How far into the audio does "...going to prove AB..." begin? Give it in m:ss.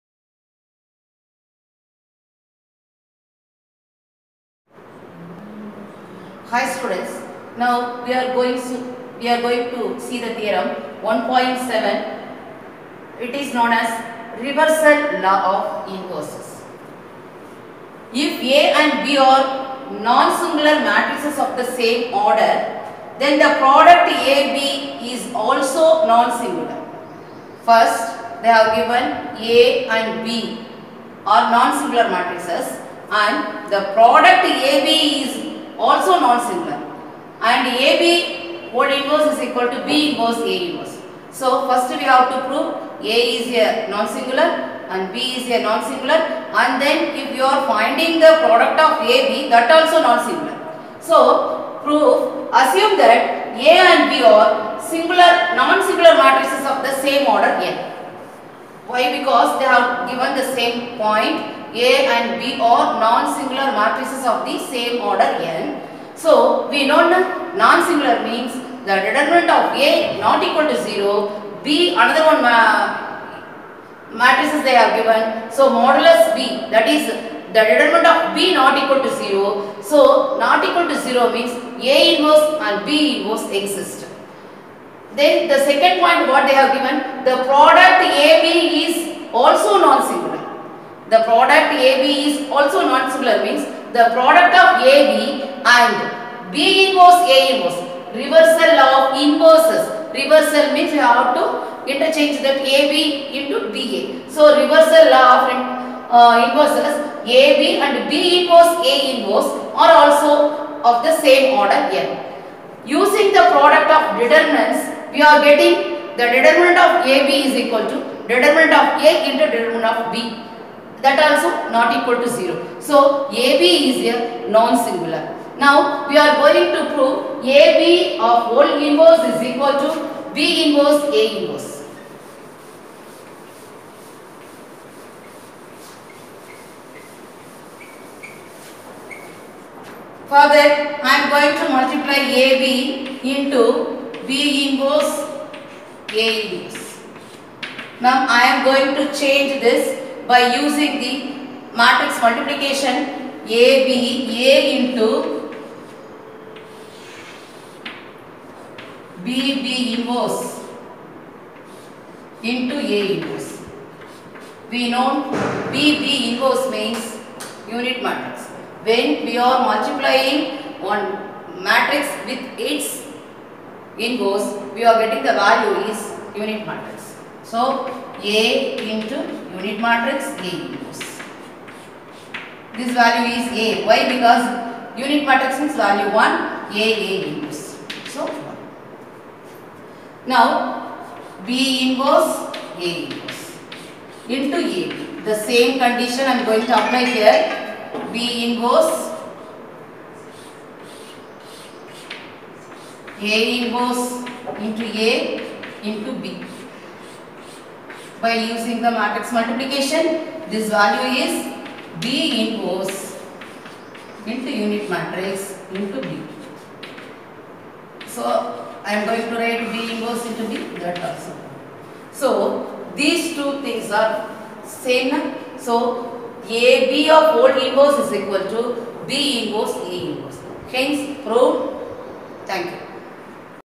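2:06.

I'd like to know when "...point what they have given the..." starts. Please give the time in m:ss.
1:26.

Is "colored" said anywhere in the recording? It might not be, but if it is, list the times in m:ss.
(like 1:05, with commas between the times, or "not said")
not said.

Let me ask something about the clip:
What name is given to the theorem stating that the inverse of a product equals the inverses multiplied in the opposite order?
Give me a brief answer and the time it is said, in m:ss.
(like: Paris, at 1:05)
Reversal law of inverses, at 0:14.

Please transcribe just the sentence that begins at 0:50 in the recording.
So proof assume that A and B are singular non-singular matrices of the same order N.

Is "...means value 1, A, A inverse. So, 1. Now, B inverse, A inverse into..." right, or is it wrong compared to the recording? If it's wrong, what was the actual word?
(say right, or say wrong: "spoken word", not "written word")
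right.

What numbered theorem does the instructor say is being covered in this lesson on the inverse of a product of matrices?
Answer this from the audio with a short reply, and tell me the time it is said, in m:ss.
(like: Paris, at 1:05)
1.7, at 0:11.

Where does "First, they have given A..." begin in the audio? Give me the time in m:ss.
0:27.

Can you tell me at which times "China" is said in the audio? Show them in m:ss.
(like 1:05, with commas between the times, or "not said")
not said.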